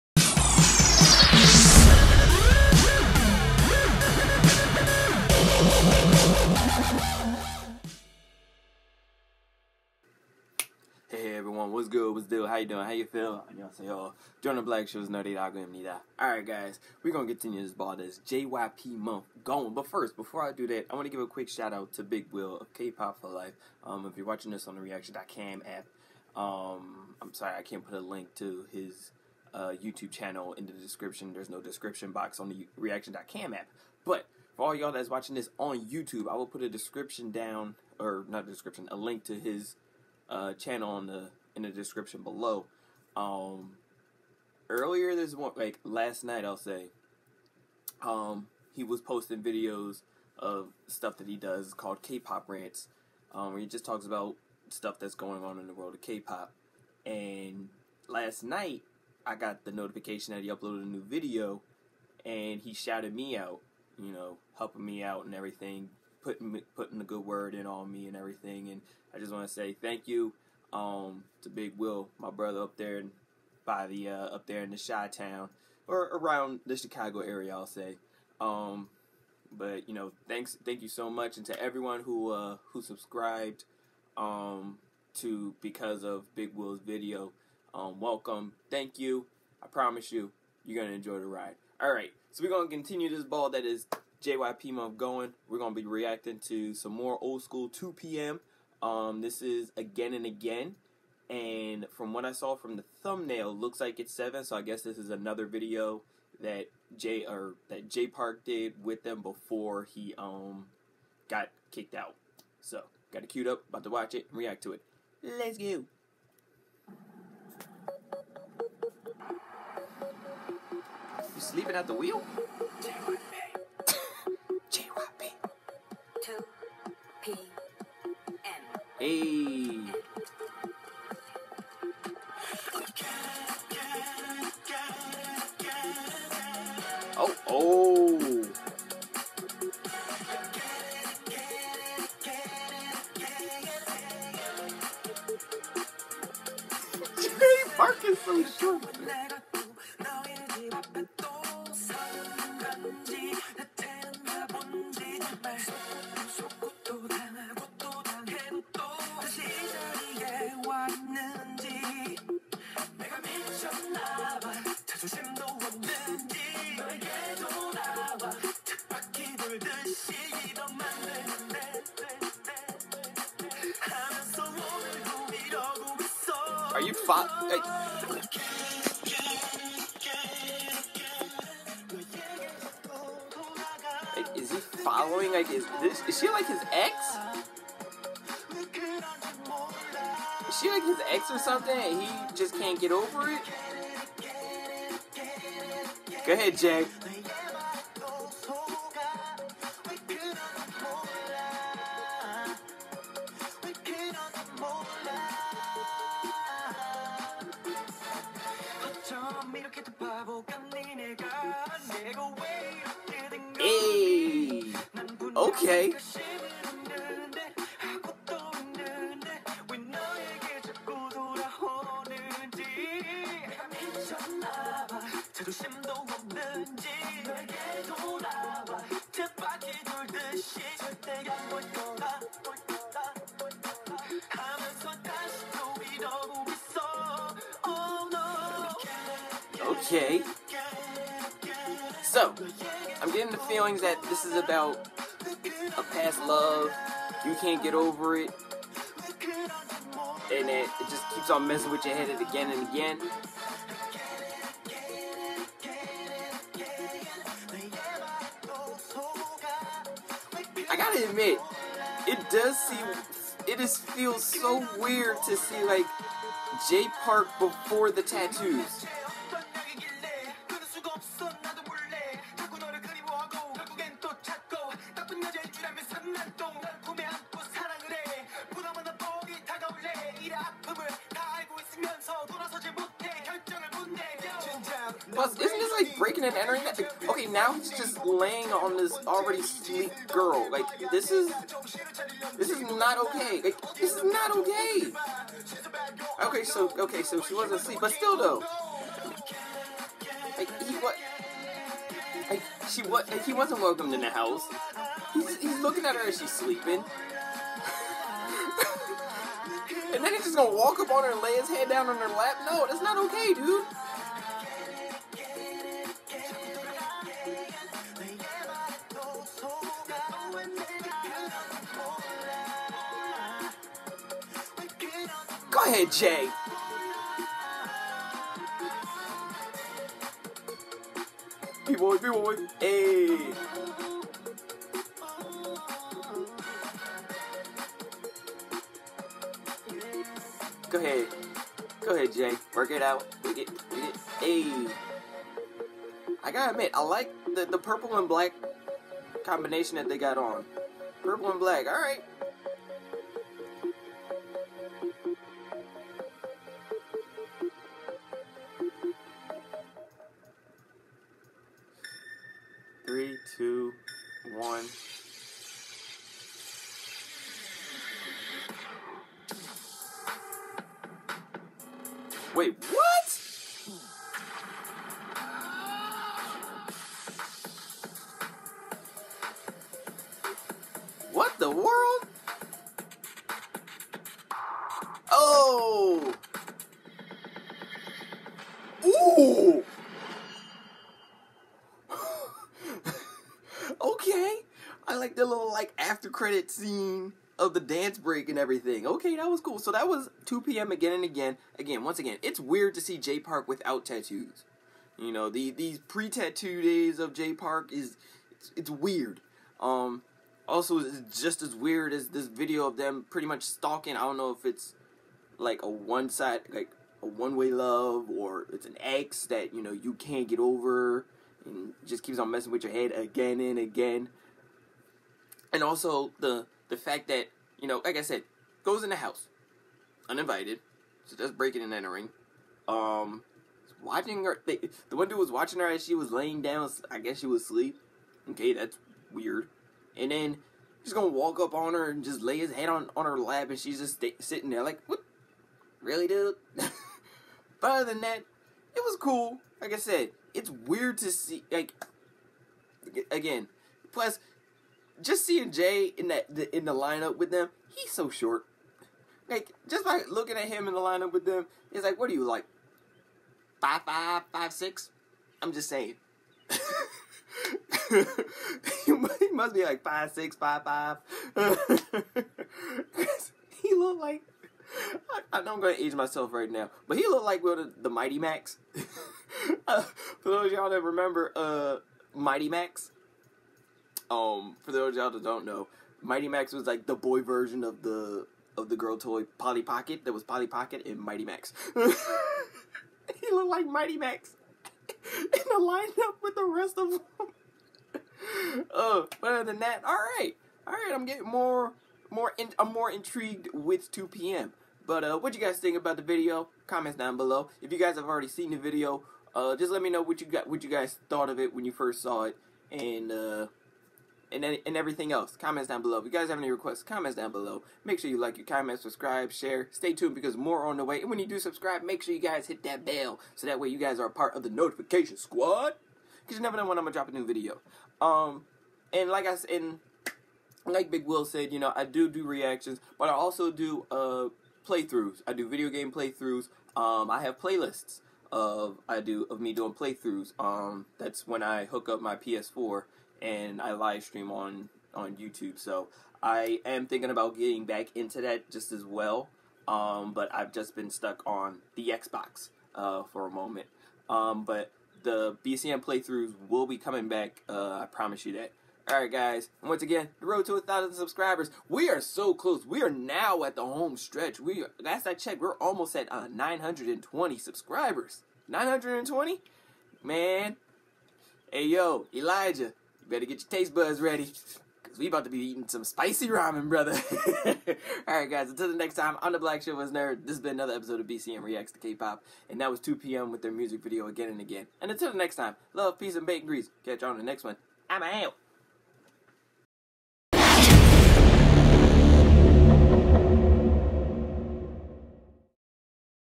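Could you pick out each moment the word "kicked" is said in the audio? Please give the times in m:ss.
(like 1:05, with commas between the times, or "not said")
1:51.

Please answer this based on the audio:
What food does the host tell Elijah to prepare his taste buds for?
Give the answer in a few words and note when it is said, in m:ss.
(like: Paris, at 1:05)
Spicy ramen, at 9:35.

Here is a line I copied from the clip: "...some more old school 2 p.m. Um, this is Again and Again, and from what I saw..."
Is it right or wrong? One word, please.
right.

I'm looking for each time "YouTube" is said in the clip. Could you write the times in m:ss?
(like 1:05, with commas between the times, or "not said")
0:29, 0:35, 9:05.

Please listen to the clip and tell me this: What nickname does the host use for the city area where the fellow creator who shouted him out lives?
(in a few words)
Chi Town.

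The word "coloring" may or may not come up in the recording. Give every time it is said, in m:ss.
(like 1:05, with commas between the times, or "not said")
not said.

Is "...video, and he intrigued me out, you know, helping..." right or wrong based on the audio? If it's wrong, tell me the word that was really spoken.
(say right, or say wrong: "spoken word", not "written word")
wrong: "shouted", not "intrigued".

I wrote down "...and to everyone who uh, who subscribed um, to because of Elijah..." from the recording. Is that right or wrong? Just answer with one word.
wrong.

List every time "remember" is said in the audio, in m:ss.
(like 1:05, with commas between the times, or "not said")
8:00.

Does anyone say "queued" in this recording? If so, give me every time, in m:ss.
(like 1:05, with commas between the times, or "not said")
1:53.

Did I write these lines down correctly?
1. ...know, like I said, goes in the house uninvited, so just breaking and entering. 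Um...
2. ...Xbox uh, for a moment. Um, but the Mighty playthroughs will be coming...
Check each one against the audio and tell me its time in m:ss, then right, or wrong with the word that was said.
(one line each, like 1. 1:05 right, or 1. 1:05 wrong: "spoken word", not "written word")
1. 7:07 right
2. 9:11 wrong: "BCM", not "Mighty".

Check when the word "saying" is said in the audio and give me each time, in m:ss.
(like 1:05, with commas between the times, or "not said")
7:45.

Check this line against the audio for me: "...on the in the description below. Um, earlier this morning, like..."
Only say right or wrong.
right.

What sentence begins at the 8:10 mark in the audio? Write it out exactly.
That was Polly Pocket and Mighty Max.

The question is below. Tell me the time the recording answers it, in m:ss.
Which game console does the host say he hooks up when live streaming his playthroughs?
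9:02.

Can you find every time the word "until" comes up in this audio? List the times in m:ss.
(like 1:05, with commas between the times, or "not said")
9:38, 9:44.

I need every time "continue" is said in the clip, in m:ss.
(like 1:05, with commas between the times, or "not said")
0:17, 1:32.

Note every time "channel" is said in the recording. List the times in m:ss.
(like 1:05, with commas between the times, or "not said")
0:30, 0:40.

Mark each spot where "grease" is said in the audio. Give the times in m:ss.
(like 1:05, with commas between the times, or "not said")
9:46.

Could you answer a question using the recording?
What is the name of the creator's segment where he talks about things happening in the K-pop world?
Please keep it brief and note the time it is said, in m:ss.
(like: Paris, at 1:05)
K-pop rants, at 0:52.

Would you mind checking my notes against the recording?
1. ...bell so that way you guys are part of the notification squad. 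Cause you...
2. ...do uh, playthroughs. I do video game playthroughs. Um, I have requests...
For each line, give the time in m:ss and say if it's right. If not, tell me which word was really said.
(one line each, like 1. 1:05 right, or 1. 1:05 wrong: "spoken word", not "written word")
1. 8:42 right
2. 8:53 wrong: "playlists", not "requests".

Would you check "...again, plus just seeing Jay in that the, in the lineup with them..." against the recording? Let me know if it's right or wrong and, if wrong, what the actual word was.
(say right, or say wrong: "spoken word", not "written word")
right.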